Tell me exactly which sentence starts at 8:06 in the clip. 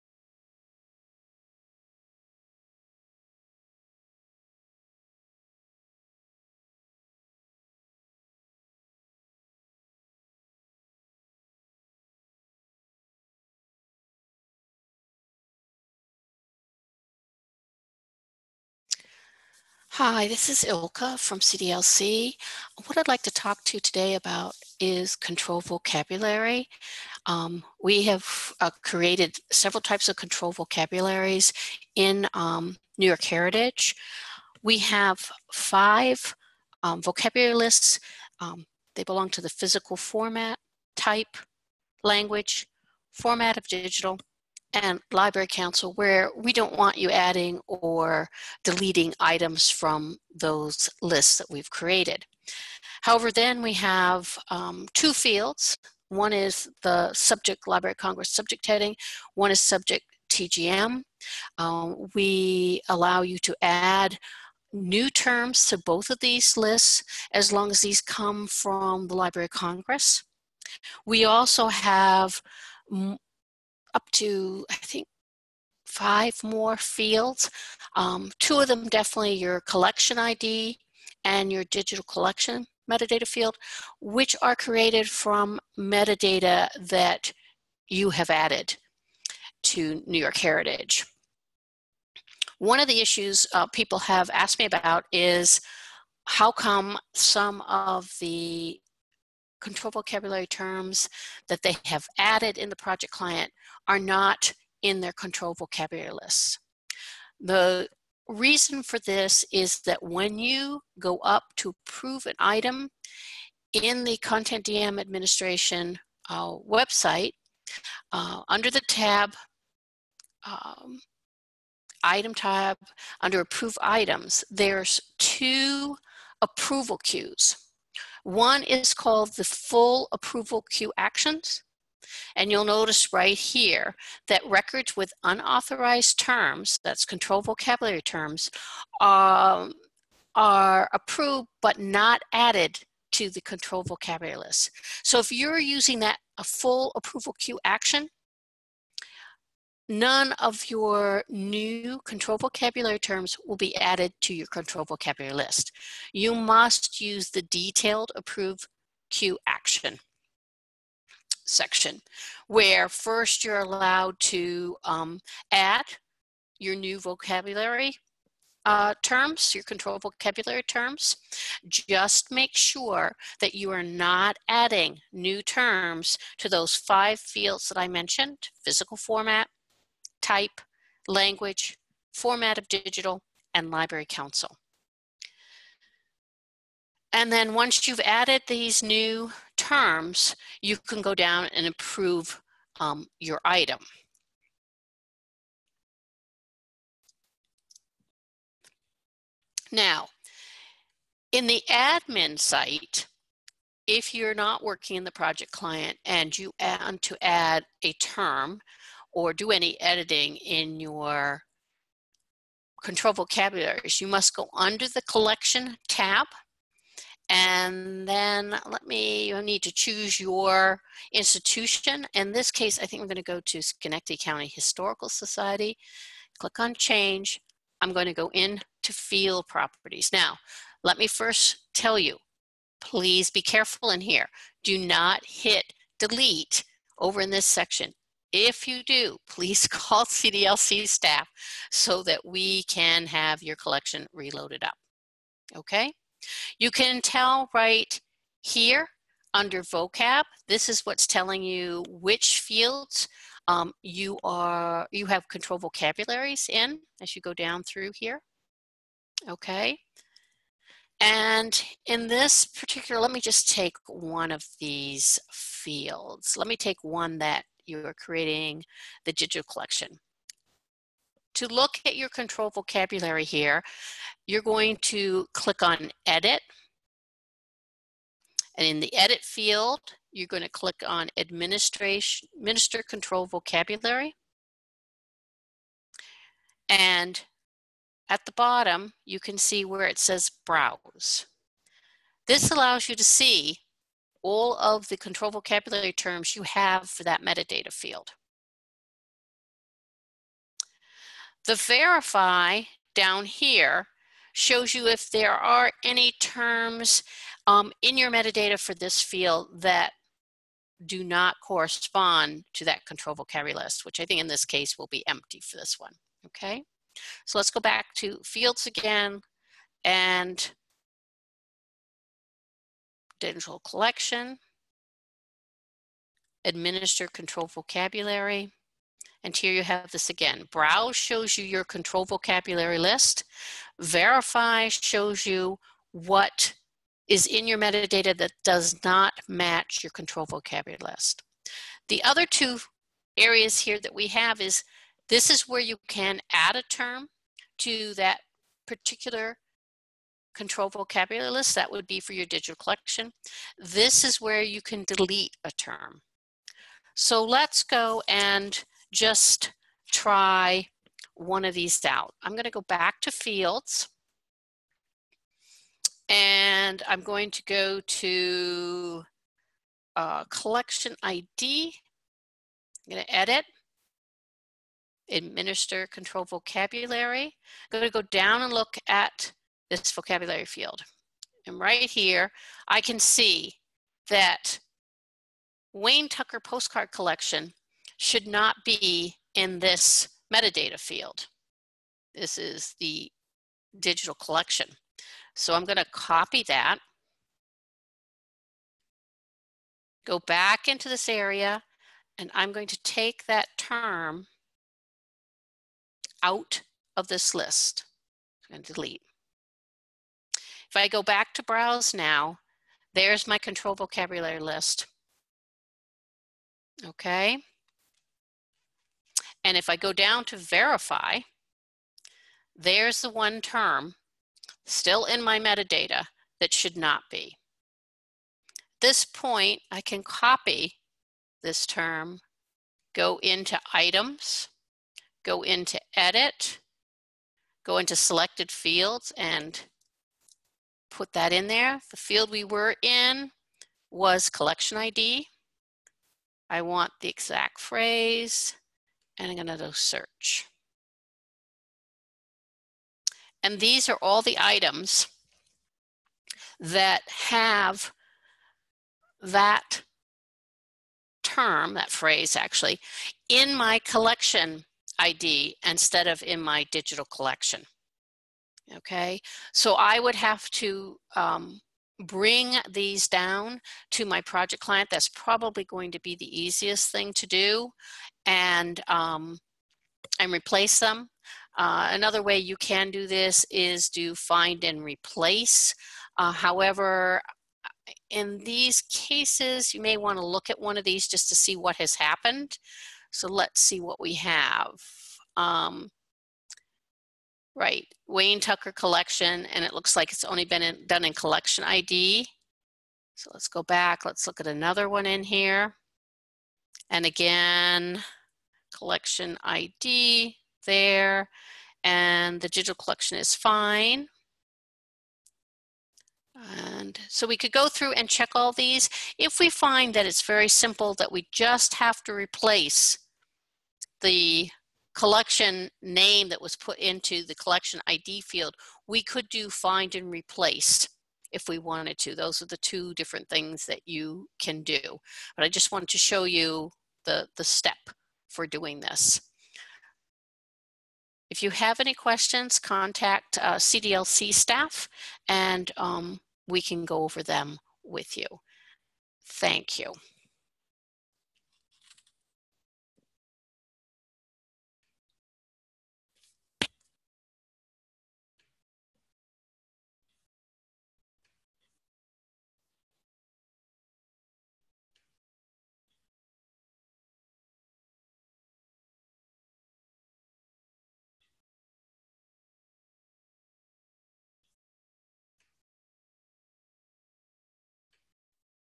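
Uh, however, in these cases, you may want to look at one of these just to see what has happened.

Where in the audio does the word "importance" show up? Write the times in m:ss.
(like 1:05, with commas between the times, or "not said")
not said.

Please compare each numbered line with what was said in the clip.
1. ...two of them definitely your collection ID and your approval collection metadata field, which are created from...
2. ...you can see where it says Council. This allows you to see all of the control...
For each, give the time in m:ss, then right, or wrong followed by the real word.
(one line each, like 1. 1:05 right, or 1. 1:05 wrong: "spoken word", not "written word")
1. 1:18 wrong: "digital", not "approval"
2. 4:49 wrong: "Browse", not "Council".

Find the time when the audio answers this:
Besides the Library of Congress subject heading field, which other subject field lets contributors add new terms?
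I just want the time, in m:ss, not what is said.
0:59.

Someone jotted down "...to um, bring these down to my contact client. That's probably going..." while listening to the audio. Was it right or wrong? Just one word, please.
wrong.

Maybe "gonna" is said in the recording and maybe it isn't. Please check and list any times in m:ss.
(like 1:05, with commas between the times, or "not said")
3:43, 3:47, 7:29.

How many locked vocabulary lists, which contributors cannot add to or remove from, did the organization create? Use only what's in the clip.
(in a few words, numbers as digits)
5.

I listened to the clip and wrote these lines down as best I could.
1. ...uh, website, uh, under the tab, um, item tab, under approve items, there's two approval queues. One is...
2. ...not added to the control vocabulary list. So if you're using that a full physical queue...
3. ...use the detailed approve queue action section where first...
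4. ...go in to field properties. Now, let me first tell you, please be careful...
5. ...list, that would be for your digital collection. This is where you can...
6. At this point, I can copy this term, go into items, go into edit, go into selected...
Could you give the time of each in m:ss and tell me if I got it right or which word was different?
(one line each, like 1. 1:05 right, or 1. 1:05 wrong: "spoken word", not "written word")
1. 1:56 right
2. 2:21 wrong: "approval", not "physical"
3. 2:37 right
4. 3:48 right
5. 5:51 right
6. 7:08 right.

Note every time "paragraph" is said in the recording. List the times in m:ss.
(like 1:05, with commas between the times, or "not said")
not said.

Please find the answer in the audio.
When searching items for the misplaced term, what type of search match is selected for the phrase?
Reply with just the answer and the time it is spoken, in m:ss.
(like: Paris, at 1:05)
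exact phrase, at 7:27.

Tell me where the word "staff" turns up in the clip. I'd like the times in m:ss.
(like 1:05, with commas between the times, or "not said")
4:00, 9:04.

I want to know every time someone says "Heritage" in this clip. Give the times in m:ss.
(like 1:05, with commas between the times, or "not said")
0:33, 1:30.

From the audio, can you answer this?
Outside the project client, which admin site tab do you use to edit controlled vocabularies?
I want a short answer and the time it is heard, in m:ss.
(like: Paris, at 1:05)
collection tab, at 3:35.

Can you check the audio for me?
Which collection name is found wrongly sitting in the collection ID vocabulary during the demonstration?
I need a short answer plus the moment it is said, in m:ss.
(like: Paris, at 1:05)
Wayne Tucker postcard collection, at 6:25.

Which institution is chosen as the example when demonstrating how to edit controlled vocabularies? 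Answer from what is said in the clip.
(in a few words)
Schenectady County Historical Society.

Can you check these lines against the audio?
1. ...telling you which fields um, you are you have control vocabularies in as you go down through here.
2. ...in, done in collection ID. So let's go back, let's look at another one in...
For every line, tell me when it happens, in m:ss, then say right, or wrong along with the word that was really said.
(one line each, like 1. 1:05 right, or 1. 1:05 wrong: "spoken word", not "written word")
1. 4:11 right
2. 8:20 right.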